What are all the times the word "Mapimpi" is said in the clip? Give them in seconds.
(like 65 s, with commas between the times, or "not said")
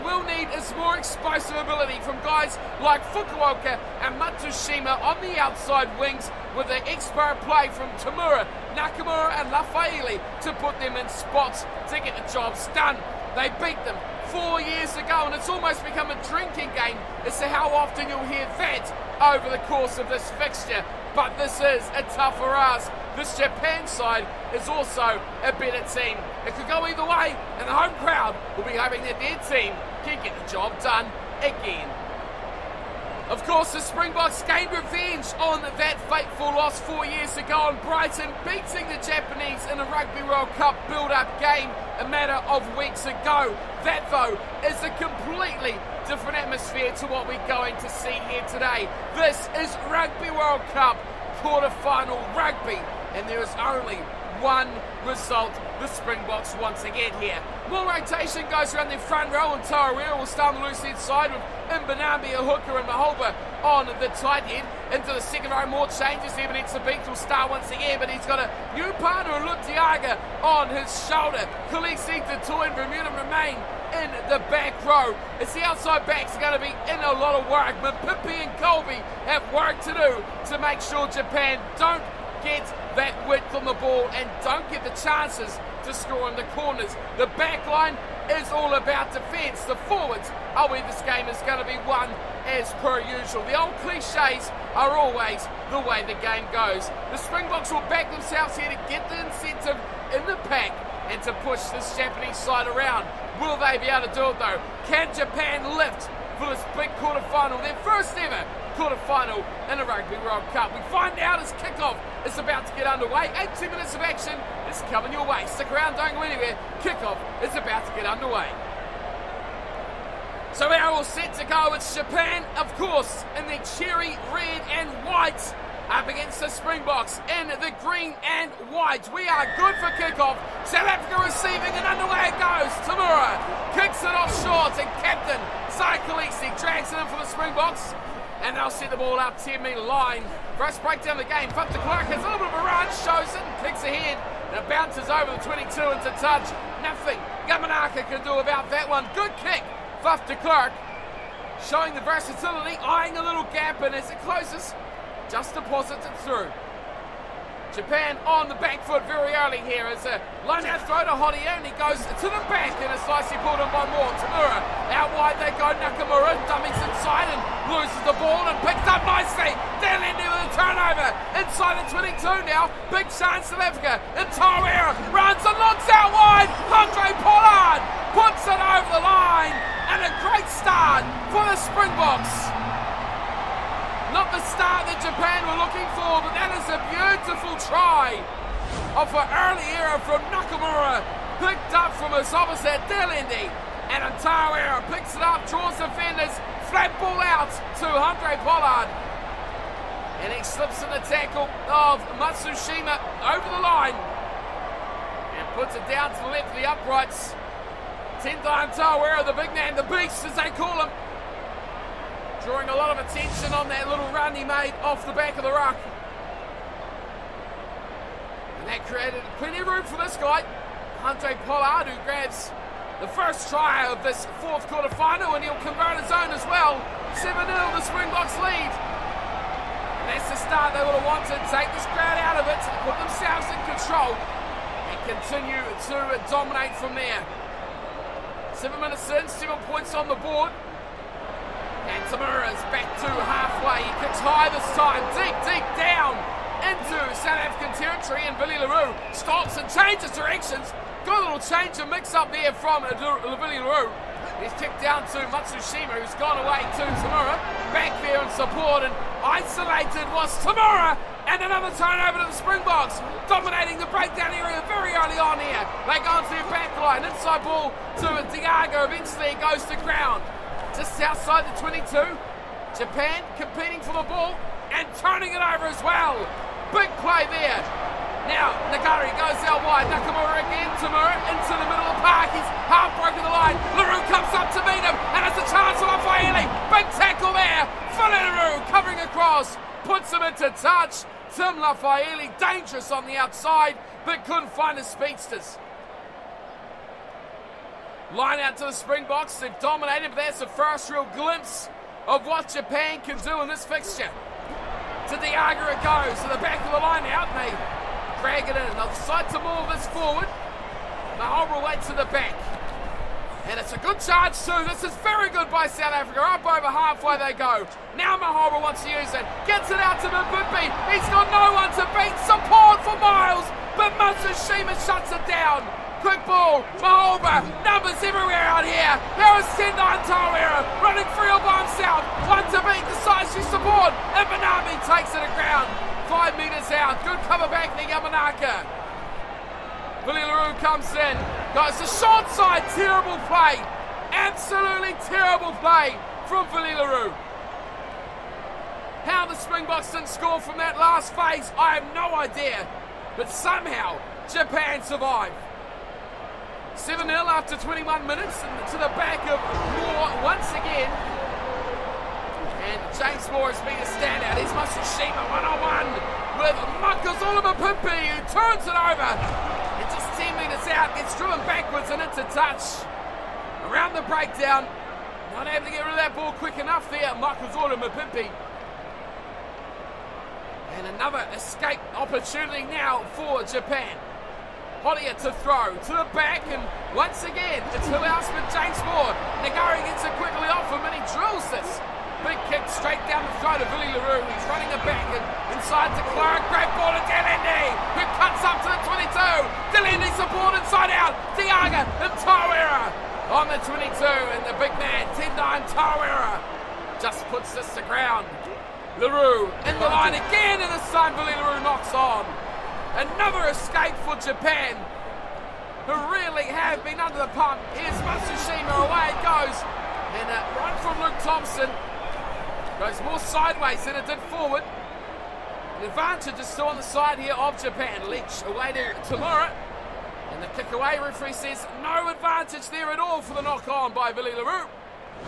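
78 s, 367 s, 377 s.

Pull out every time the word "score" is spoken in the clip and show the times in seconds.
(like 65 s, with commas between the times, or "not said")
85 s, 350 s.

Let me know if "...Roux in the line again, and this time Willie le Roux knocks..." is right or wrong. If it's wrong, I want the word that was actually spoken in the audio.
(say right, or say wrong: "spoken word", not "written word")
right.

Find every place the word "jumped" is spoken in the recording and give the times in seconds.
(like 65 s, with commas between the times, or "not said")
not said.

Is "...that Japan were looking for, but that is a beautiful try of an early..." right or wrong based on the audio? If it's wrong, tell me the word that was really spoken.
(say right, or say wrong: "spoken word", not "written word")
right.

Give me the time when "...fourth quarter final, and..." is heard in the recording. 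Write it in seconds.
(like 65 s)
224 s.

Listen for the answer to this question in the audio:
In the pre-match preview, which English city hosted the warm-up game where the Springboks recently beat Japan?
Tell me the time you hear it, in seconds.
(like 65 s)
37 s.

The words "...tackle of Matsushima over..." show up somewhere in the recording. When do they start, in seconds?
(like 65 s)
201 s.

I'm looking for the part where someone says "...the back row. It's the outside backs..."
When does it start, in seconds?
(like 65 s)
74 s.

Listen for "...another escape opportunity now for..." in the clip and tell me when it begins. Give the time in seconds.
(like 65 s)
380 s.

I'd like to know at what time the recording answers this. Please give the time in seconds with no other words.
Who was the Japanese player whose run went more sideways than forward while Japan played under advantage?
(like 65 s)
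421 s.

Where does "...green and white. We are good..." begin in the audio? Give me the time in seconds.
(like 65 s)
127 s.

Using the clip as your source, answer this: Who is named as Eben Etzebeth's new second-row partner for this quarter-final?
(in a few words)
Lutiaga.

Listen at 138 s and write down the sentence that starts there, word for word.
And they'll set the ball out 10 metre line.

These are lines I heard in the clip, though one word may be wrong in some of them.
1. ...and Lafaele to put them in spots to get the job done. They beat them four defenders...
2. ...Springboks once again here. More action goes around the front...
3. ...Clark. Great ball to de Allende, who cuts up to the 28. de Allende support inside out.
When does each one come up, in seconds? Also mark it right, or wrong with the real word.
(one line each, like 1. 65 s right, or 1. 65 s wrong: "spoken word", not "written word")
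1. 9 s wrong: "years", not "defenders"
2. 55 s wrong: "rotation", not "action"
3. 396 s wrong: "22", not "28".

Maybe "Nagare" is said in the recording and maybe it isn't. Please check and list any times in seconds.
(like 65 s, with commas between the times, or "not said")
278 s, 389 s.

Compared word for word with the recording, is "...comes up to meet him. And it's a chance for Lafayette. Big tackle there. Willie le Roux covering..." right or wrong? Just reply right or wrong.
right.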